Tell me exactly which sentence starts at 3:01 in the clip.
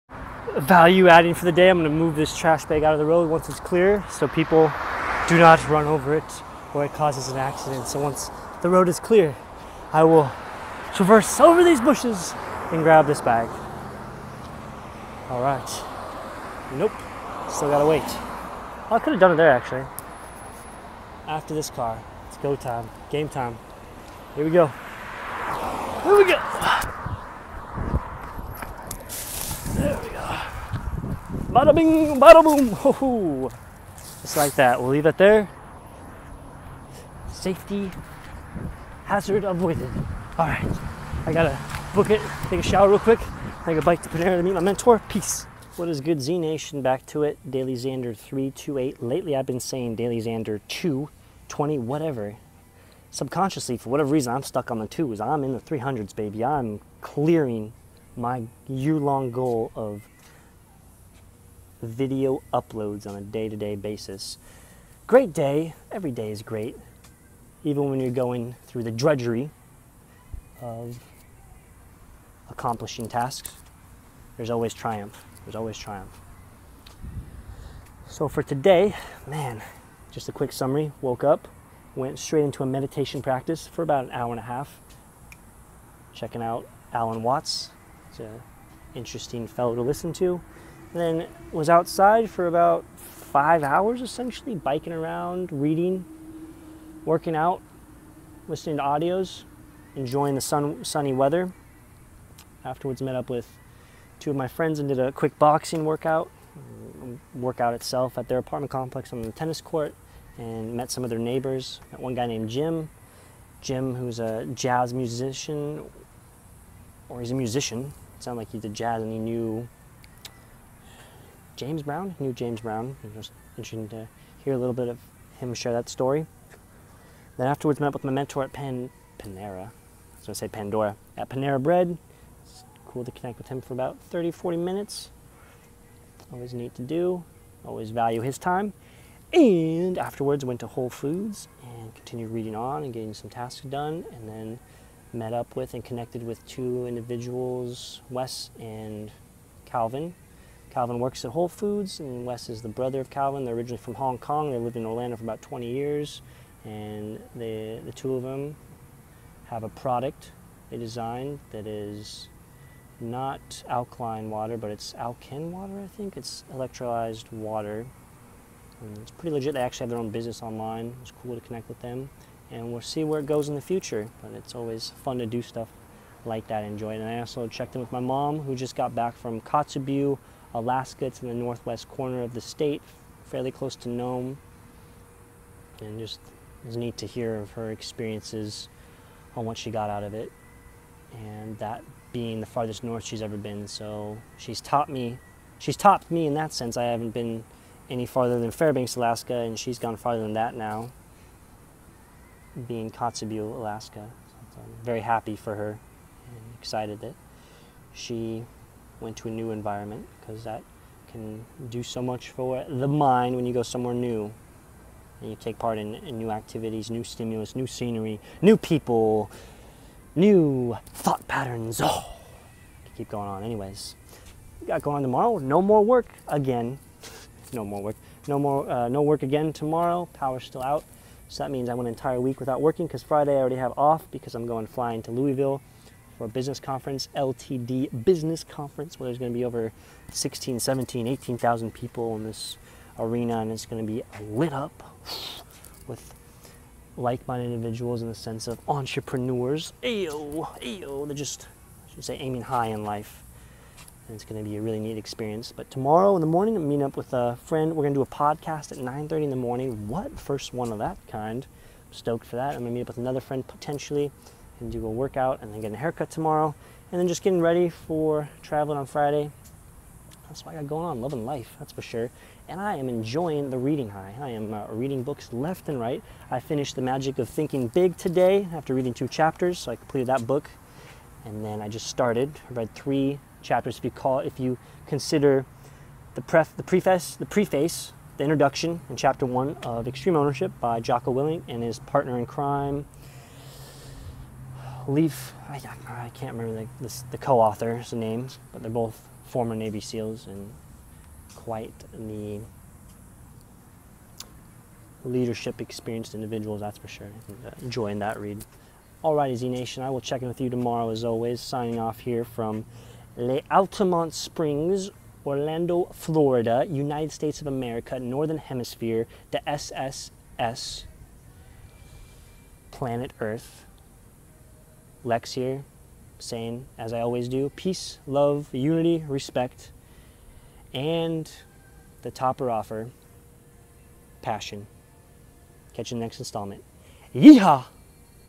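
It's in the northwest corner of the state, fairly close to Nome.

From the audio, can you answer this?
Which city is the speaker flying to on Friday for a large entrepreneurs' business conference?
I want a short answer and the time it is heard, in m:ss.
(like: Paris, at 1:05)
Louisville, at 3:55.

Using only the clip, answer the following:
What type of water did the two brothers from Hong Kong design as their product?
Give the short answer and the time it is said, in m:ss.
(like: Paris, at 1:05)
Electrolyzed water, at 2:46.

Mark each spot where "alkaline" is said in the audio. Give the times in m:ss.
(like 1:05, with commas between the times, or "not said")
2:43.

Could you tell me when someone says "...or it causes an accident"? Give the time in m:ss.
0:06.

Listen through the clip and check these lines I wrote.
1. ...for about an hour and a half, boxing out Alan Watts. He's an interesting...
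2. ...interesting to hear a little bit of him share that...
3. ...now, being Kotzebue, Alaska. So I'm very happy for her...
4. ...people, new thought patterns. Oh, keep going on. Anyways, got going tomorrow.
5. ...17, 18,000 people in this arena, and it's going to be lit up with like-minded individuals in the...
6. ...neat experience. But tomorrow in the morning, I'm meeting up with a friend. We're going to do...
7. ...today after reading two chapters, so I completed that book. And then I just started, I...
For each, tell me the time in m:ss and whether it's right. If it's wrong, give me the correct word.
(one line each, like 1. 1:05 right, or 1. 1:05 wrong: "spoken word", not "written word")
1. 1:23 wrong: "checking", not "boxing"
2. 2:03 right
3. 3:20 right
4. 3:38 right
5. 4:00 right
6. 4:14 right
7. 4:37 right.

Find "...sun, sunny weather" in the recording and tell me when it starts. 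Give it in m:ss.
1:40.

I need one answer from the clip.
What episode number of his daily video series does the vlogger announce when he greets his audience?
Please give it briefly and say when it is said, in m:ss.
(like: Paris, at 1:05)
328, at 0:47.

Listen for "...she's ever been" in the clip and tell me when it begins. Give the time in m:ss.
3:13.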